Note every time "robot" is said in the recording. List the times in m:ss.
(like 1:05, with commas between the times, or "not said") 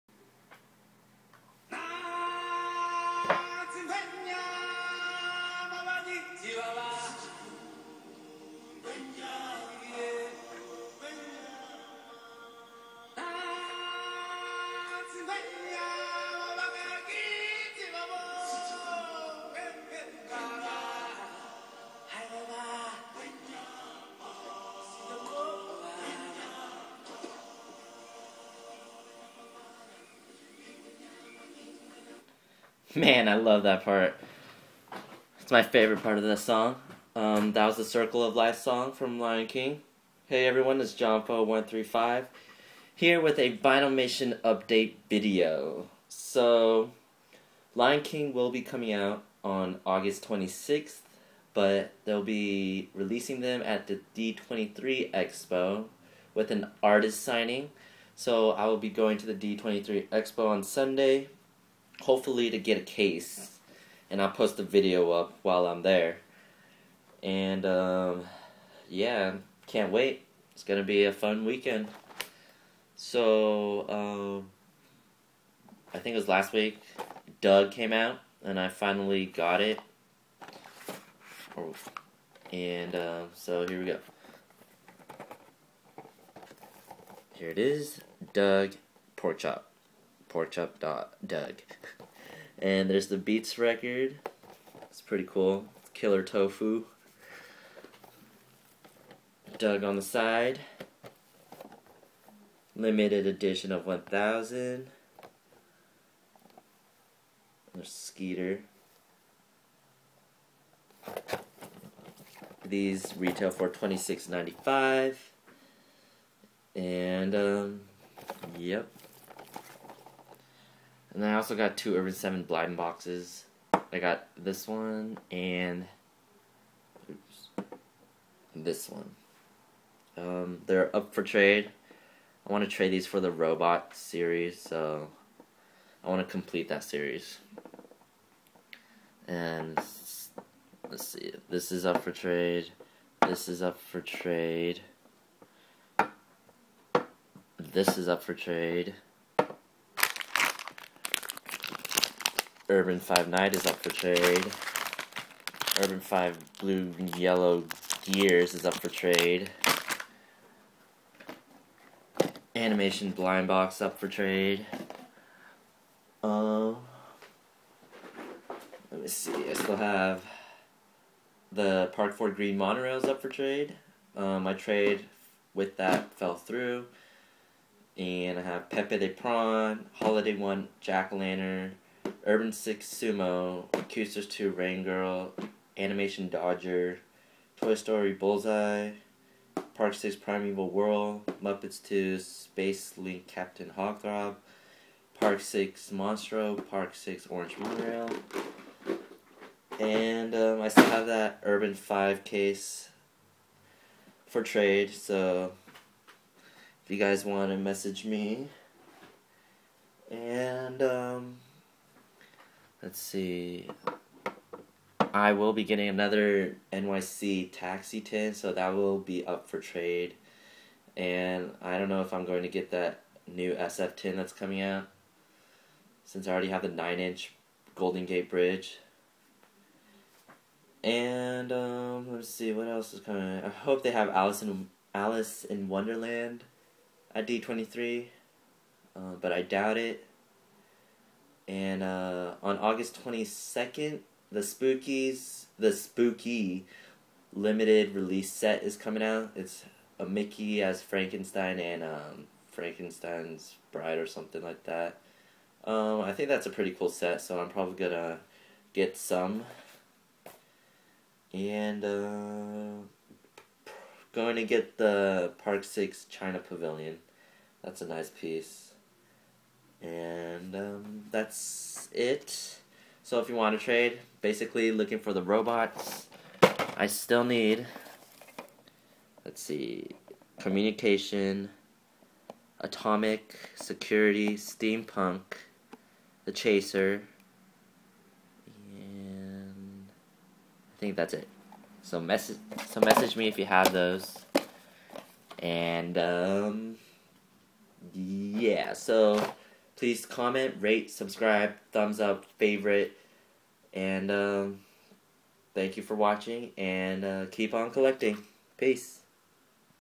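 2:13, 4:35.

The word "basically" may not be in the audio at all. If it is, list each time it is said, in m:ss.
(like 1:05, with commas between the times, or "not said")
4:34.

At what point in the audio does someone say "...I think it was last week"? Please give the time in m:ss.
1:15.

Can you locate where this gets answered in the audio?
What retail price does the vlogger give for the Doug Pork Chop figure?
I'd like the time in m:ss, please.
1:53.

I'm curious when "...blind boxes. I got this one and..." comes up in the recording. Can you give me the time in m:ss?
2:02.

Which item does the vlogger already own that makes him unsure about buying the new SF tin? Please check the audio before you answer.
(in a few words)
9 inch Golden Gate Bridge.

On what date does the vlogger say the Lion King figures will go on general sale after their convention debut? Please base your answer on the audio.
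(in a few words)
August 26th.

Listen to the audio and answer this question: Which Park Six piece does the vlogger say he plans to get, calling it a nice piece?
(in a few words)
China Pavilion.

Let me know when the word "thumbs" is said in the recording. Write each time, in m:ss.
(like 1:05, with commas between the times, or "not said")
5:01.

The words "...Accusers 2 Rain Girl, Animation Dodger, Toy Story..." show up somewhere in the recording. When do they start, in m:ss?
3:03.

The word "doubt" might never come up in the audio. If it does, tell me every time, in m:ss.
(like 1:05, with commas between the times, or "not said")
3:59.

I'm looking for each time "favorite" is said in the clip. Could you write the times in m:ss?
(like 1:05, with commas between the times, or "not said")
0:35, 5:02.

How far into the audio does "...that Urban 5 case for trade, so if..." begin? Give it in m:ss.
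3:21.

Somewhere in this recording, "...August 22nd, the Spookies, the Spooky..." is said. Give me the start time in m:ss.
4:02.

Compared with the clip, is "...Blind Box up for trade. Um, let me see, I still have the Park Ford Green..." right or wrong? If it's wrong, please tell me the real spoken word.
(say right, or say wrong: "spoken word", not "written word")
right.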